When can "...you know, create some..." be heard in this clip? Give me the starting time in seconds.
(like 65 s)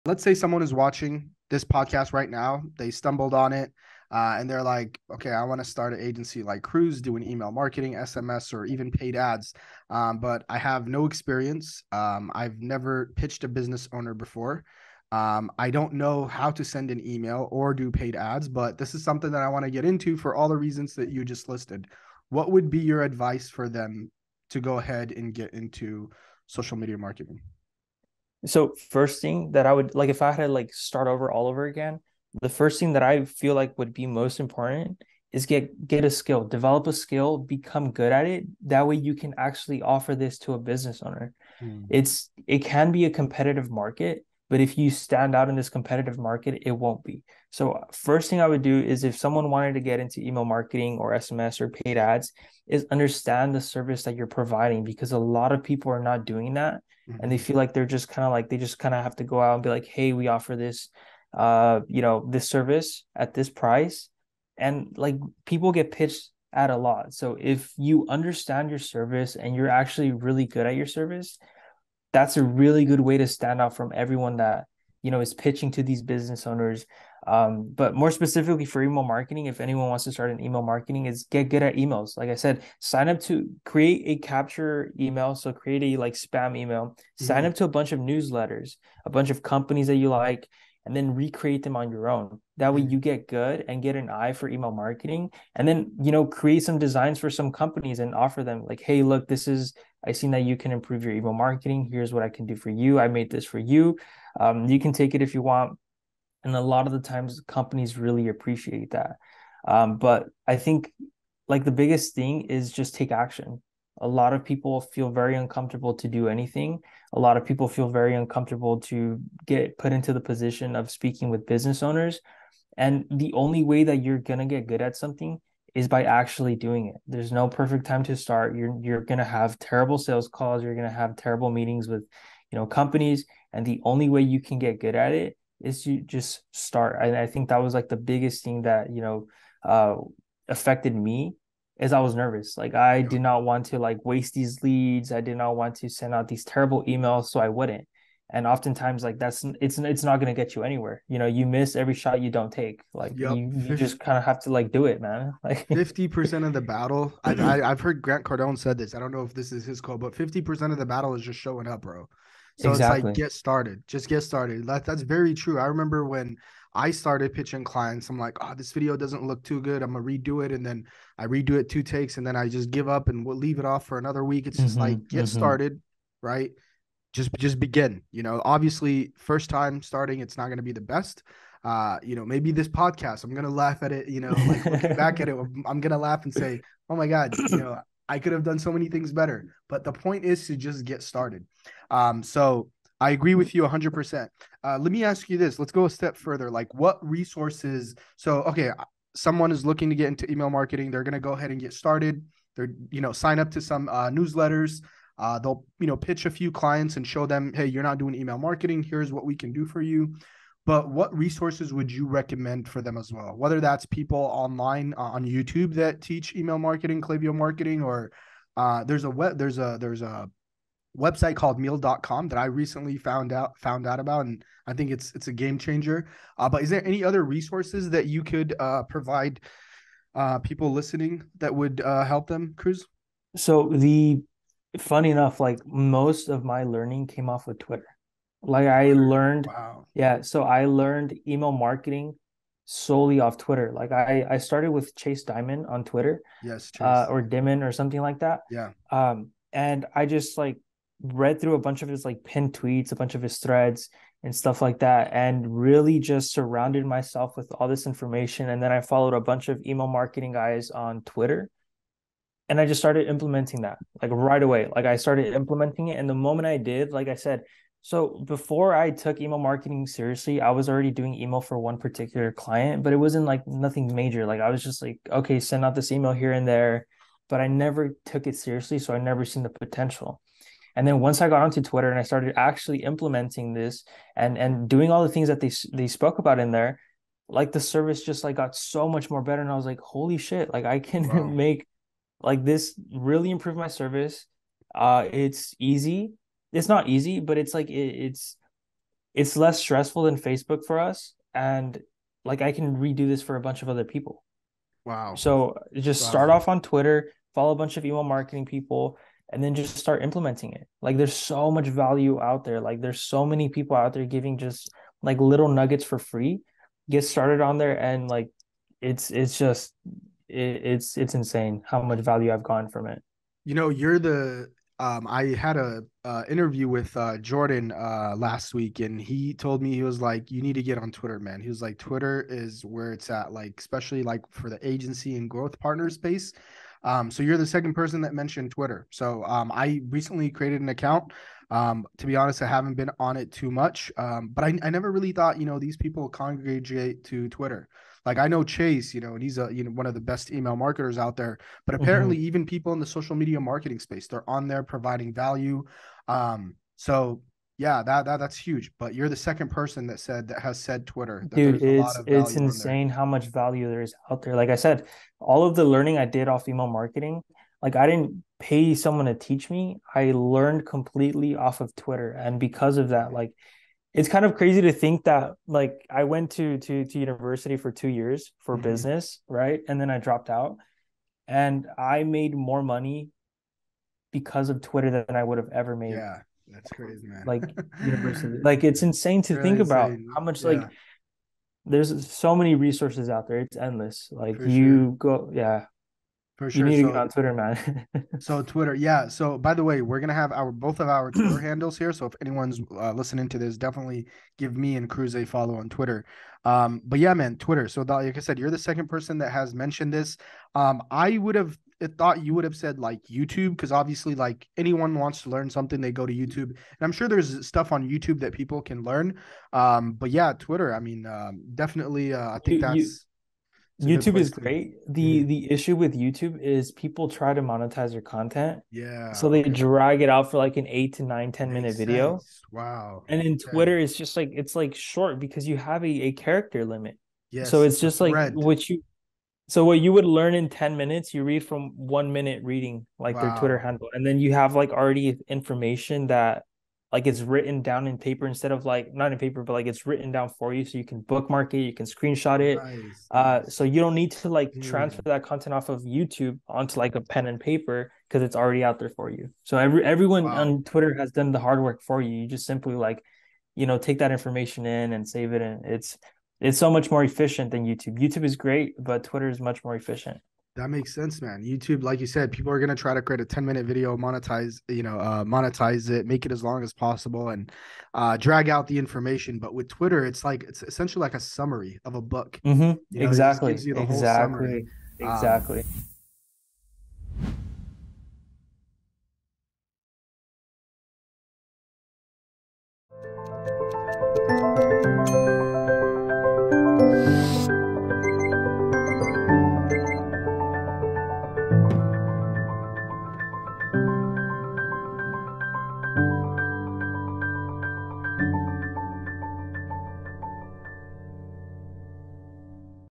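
96 s.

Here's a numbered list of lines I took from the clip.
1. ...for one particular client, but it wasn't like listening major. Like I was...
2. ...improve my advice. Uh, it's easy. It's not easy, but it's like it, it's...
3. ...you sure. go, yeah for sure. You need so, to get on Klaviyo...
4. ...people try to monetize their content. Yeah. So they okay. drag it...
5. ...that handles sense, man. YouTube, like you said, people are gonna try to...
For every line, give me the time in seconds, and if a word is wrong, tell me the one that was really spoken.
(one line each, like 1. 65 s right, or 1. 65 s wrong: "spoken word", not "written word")
1. 271 s wrong: "nothing", not "listening"
2. 293 s wrong: "service", not "advice"
3. 394 s wrong: "Twitter", not "Klaviyo"
4. 426 s right
5. 470 s wrong: "makes", not "handles".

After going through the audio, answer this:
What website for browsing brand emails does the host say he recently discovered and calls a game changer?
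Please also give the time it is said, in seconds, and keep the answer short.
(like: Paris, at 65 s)
milled.com, at 221 s.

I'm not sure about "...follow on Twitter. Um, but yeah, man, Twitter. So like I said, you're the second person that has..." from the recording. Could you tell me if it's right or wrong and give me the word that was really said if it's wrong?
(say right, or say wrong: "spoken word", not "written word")
right.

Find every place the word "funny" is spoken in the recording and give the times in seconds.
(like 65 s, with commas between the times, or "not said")
234 s.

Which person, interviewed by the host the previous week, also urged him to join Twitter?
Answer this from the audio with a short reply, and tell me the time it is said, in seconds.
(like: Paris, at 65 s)
Jordan, at 327 s.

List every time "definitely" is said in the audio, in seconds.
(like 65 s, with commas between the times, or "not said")
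403 s, 421 s.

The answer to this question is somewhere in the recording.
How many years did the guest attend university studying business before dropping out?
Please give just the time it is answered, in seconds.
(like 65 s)
377 s.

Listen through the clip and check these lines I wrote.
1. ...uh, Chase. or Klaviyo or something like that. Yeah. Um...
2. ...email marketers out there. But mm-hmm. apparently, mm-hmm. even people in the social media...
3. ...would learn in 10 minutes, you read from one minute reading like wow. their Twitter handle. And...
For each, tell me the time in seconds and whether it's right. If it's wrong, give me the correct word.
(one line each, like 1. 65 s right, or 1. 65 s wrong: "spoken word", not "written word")
1. 246 s wrong: "Dimon", not "Klaviyo"
2. 350 s right
3. 439 s right.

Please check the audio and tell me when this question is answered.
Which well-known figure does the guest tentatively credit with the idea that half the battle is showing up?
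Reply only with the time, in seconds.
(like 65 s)
158 s.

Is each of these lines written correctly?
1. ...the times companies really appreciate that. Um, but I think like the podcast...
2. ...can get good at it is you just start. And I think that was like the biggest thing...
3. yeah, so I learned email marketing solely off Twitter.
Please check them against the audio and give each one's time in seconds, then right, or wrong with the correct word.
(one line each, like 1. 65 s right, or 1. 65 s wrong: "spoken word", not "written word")
1. 106 s wrong: "biggest", not "podcast"
2. 134 s right
3. 239 s right.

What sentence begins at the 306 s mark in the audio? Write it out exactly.
start off on Twitter, follow a bunch of email marketing people, and then just start implementing it.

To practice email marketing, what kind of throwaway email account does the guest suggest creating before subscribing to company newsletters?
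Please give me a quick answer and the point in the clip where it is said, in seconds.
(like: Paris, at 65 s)
spam email, at 86 s.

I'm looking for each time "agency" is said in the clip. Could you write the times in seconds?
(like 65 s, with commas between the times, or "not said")
6 s, 334 s.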